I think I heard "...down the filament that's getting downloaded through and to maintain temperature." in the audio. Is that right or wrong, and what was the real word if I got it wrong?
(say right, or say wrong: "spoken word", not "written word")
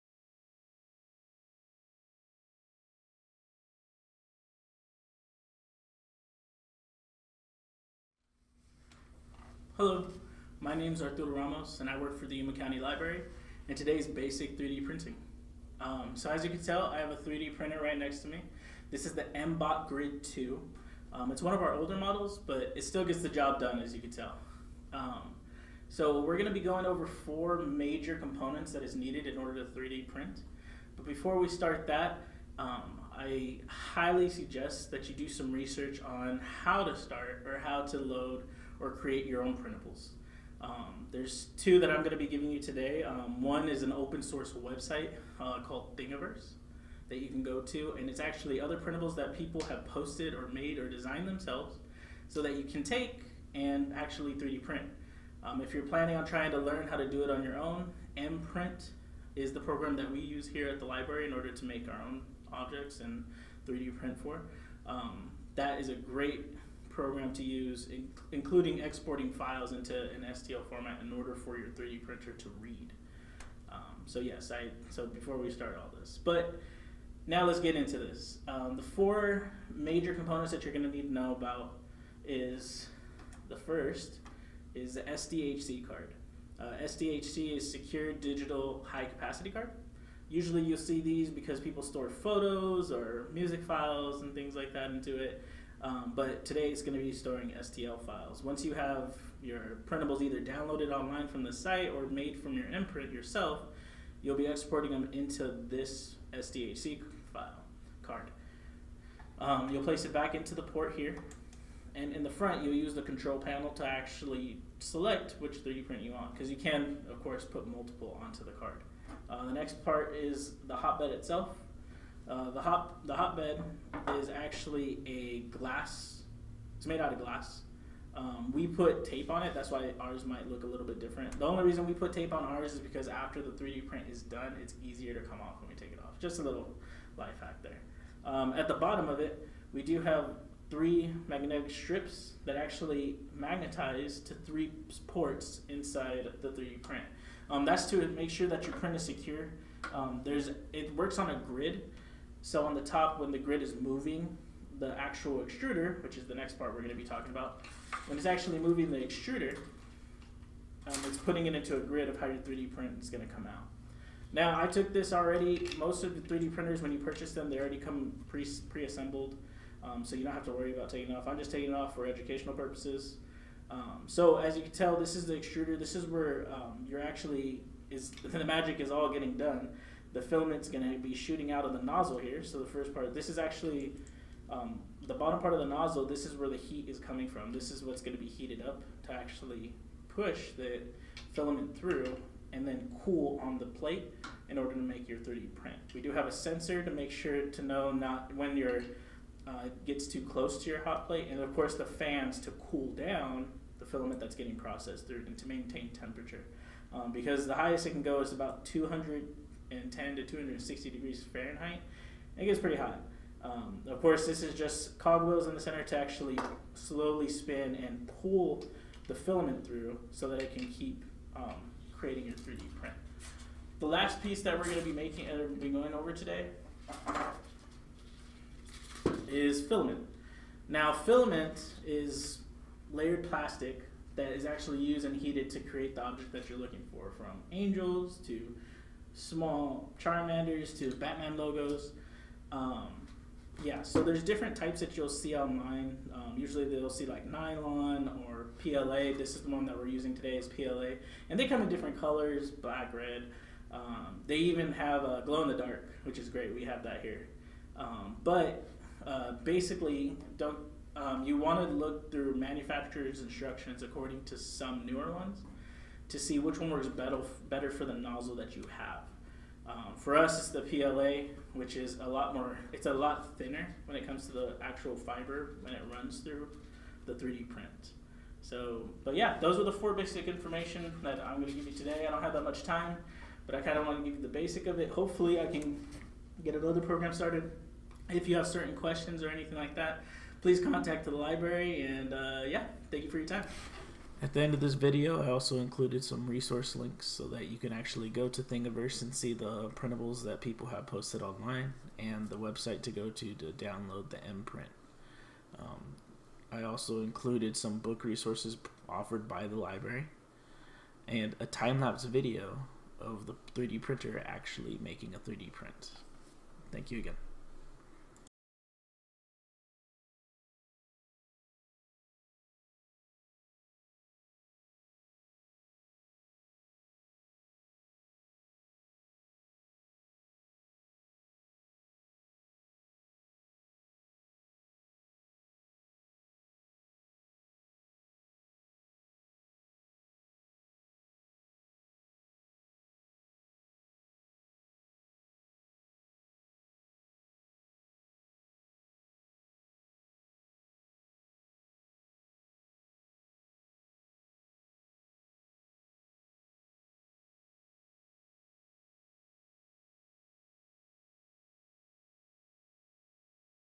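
wrong: "processed", not "downloaded".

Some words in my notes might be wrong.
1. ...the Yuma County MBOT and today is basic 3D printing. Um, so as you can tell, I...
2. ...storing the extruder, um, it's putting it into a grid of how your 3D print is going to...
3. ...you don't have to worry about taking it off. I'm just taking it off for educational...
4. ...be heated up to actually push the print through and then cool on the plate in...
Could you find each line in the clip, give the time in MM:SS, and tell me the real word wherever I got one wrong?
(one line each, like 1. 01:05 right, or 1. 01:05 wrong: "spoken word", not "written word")
1. 00:12 wrong: "Library", not "MBOT"
2. 02:38 wrong: "moving", not "storing"
3. 02:50 right
4. 03:08 wrong: "filament", not "print".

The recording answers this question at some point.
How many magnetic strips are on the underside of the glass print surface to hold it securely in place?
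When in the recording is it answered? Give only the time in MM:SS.
02:20.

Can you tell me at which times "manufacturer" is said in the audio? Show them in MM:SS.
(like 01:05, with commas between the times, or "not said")
04:22.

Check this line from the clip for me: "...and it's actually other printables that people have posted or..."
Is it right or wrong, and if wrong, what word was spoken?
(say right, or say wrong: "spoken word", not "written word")
right.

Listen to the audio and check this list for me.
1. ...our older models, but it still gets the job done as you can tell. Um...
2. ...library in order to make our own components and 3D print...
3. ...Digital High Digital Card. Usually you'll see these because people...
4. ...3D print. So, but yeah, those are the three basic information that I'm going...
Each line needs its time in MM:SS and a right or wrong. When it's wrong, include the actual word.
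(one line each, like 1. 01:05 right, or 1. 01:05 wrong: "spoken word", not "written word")
1. 00:21 right
2. 01:00 wrong: "objects", not "components"
3. 01:28 wrong: "Capacity", not "Digital"
4. 04:37 wrong: "four", not "three".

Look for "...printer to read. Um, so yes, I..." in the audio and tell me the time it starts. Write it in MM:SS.
01:12.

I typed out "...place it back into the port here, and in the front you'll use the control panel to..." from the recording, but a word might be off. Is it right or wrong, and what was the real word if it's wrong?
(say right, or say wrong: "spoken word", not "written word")
right.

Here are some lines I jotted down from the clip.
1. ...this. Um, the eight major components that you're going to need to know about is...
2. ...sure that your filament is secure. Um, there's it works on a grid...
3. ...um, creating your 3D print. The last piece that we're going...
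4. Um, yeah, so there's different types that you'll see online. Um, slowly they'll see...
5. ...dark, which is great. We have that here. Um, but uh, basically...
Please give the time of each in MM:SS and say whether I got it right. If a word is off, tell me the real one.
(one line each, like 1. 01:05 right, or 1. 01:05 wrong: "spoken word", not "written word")
1. 01:17 wrong: "four", not "eight"
2. 02:28 wrong: "print", not "filament"
3. 03:41 right
4. 04:02 wrong: "usually", not "slowly"
5. 04:15 right.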